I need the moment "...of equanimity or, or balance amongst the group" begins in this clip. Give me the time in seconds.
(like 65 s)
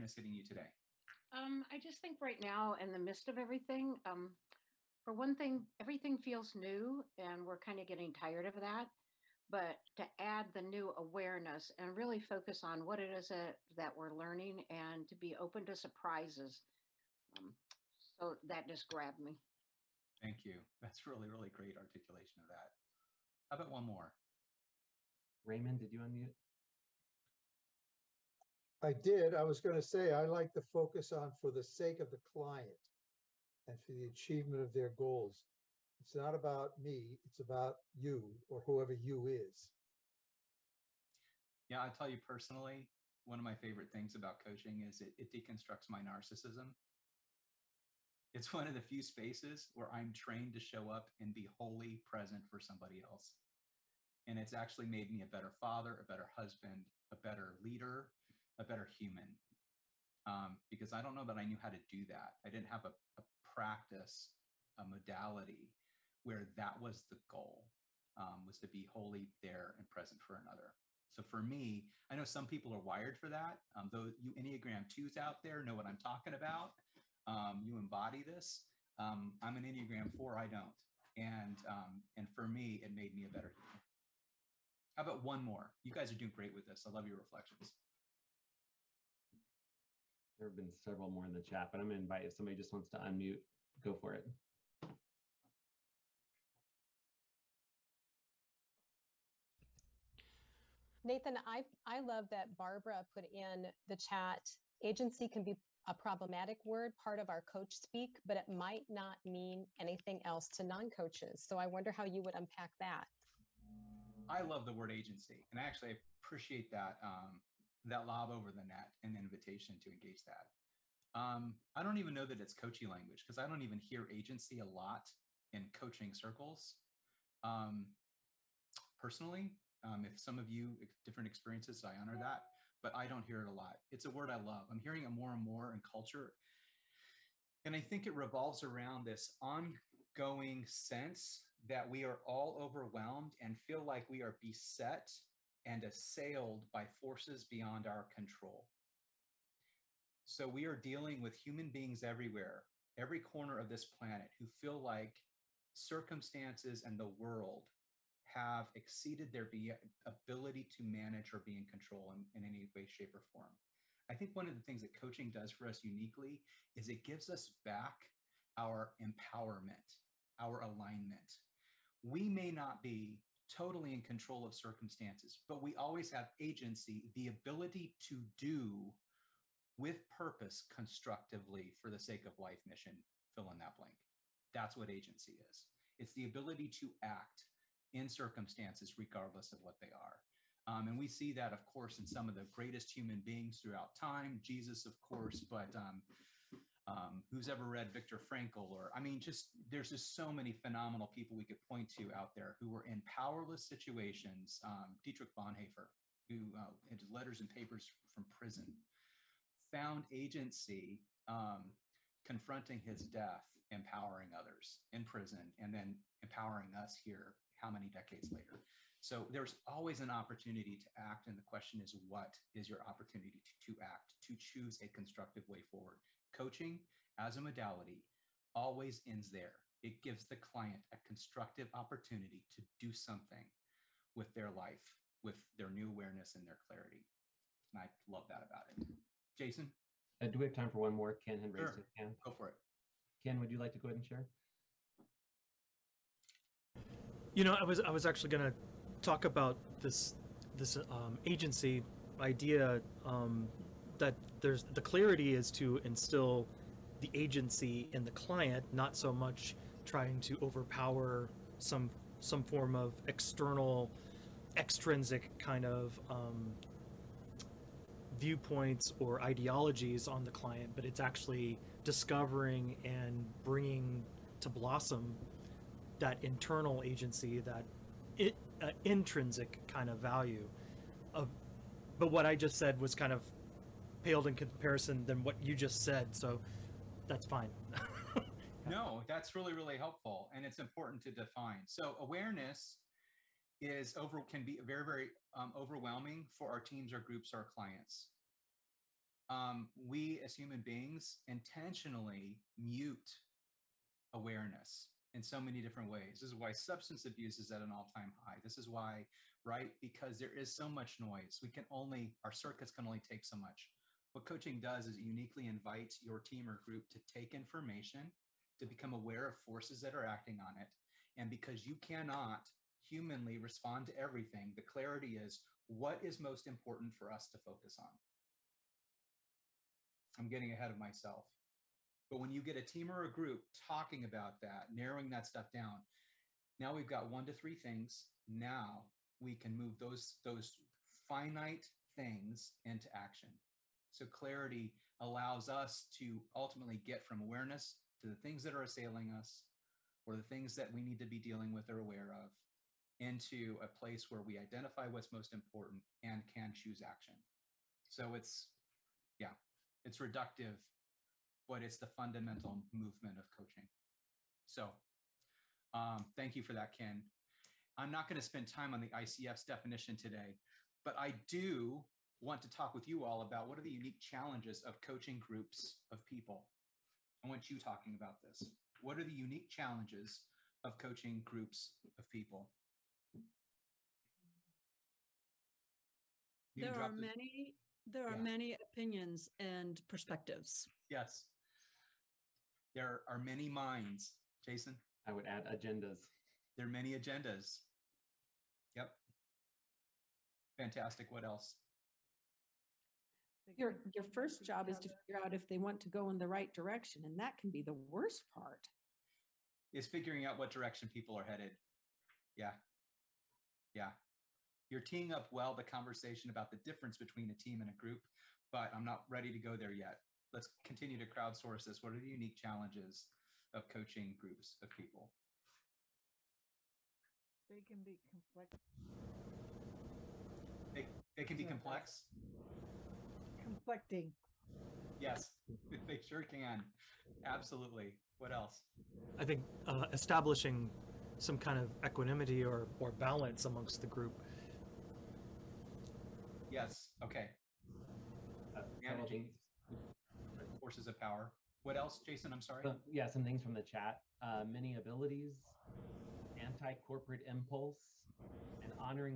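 441 s.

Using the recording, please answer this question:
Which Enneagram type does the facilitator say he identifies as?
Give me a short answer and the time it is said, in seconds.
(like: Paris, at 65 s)
Enneagram 4, at 79 s.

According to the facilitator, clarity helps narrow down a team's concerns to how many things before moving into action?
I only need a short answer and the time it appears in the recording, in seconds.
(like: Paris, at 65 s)
1 to 3, at 337 s.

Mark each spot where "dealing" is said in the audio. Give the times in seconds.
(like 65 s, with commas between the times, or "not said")
150 s, 351 s.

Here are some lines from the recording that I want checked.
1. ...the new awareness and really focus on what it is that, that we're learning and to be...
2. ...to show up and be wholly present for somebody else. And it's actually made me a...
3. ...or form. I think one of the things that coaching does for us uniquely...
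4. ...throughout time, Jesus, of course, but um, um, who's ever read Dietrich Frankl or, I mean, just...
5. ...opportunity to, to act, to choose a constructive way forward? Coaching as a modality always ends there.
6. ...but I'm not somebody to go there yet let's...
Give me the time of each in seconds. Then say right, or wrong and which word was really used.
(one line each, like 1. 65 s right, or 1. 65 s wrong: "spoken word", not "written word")
1. 10 s right
2. 50 s right
3. 163 s right
4. 193 s wrong: "Viktor", not "Dietrich"
5. 222 s right
6. 418 s wrong: "ready", not "somebody".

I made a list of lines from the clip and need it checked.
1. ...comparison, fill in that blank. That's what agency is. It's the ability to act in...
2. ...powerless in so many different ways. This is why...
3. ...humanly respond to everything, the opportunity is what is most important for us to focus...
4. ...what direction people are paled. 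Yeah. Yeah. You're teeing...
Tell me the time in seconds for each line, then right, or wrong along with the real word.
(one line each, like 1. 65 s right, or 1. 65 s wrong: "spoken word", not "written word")
1. 182 s wrong: "mission", not "comparison"
2. 304 s wrong: "awareness", not "powerless"
3. 322 s wrong: "clarity", not "opportunity"
4. 410 s wrong: "headed", not "paled".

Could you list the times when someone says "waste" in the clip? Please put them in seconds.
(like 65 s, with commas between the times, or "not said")
not said.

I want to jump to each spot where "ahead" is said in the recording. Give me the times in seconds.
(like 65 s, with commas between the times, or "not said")
243 s, 330 s.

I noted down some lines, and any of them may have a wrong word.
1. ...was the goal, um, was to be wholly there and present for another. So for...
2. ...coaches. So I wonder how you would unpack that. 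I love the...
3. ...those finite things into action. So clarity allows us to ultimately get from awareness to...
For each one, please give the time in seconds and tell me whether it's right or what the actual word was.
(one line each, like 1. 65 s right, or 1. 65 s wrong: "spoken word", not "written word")
1. 66 s right
2. 110 s right
3. 340 s right.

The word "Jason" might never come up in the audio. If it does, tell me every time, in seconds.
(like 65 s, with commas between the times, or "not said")
239 s, 394 s, 452 s.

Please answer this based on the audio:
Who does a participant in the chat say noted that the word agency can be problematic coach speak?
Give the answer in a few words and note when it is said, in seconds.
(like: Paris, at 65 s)
Barbara, at 102 s.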